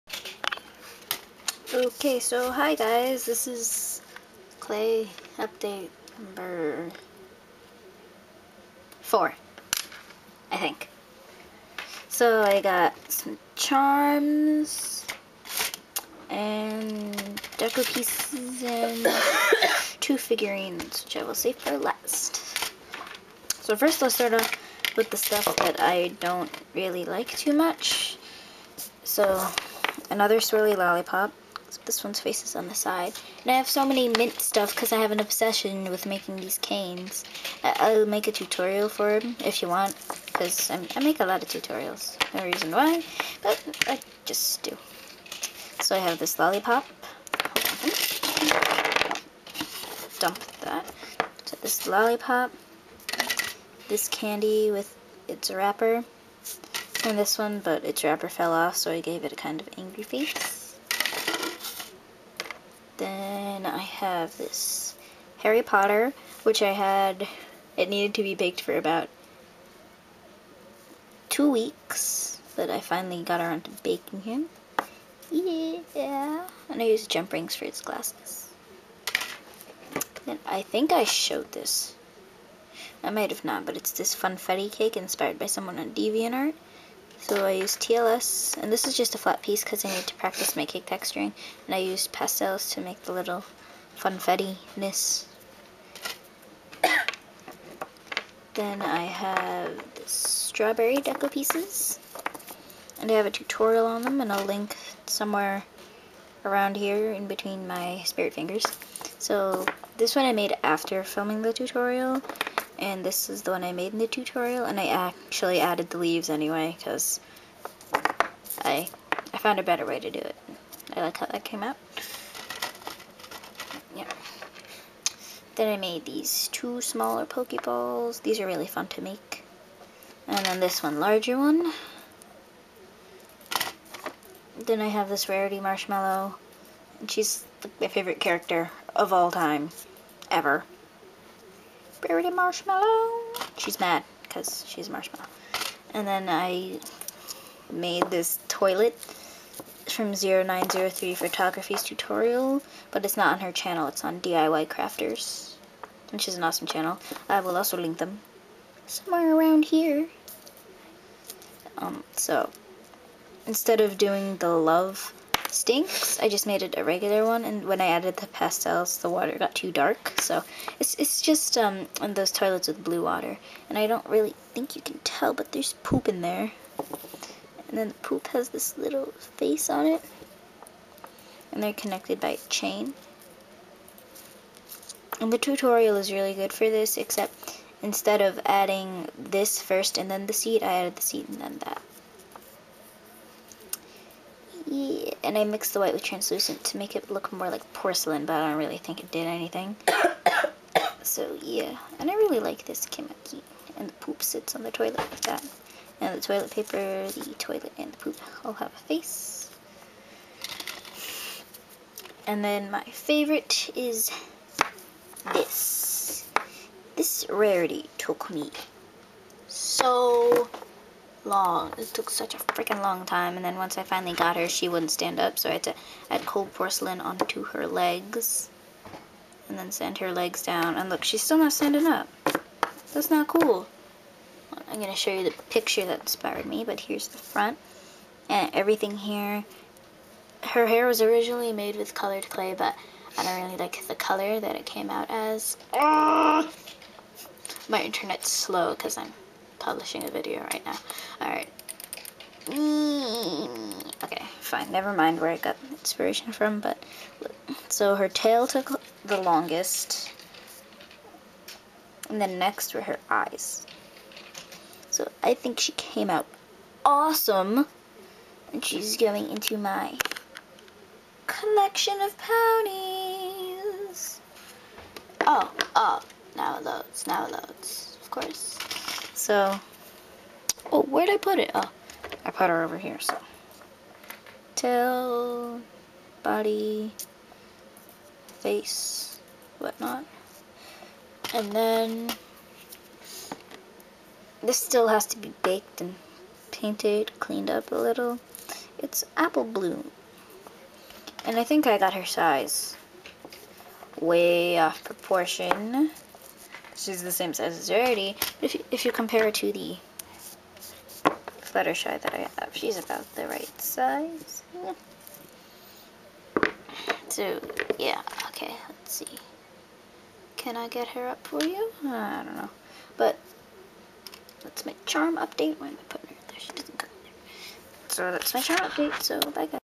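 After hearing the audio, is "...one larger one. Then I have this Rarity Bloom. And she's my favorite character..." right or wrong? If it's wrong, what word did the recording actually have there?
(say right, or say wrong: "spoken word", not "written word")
wrong: "Marshmallow", not "Bloom".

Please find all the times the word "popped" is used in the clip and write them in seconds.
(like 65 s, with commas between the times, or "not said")
not said.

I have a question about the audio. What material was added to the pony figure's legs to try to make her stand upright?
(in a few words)
cold porcelain.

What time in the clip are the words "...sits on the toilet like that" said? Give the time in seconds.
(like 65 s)
204 s.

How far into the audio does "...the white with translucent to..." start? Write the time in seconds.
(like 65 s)
195 s.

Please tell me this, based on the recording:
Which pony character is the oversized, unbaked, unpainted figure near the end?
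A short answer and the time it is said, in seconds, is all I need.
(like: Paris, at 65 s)
Apple Bloom, at 299 s.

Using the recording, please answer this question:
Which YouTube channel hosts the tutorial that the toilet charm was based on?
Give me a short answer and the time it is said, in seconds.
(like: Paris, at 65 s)
DIY Crafters, at 154 s.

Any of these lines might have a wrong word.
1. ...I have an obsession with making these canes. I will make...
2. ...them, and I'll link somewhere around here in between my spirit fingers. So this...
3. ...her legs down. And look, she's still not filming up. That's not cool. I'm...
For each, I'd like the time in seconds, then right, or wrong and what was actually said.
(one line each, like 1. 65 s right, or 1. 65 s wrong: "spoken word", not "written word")
1. 34 s right
2. 104 s right
3. 229 s wrong: "standing", not "filming".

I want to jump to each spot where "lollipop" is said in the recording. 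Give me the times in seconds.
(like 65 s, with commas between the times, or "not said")
30 s, 46 s, 51 s.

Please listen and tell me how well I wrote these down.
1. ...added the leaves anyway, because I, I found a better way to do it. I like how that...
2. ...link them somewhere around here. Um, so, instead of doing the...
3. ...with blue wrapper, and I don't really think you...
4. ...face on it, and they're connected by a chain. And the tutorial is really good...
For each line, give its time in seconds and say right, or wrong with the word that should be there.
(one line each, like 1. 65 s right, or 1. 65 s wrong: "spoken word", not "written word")
1. 115 s right
2. 157 s right
3. 172 s wrong: "water", not "wrapper"
4. 179 s right.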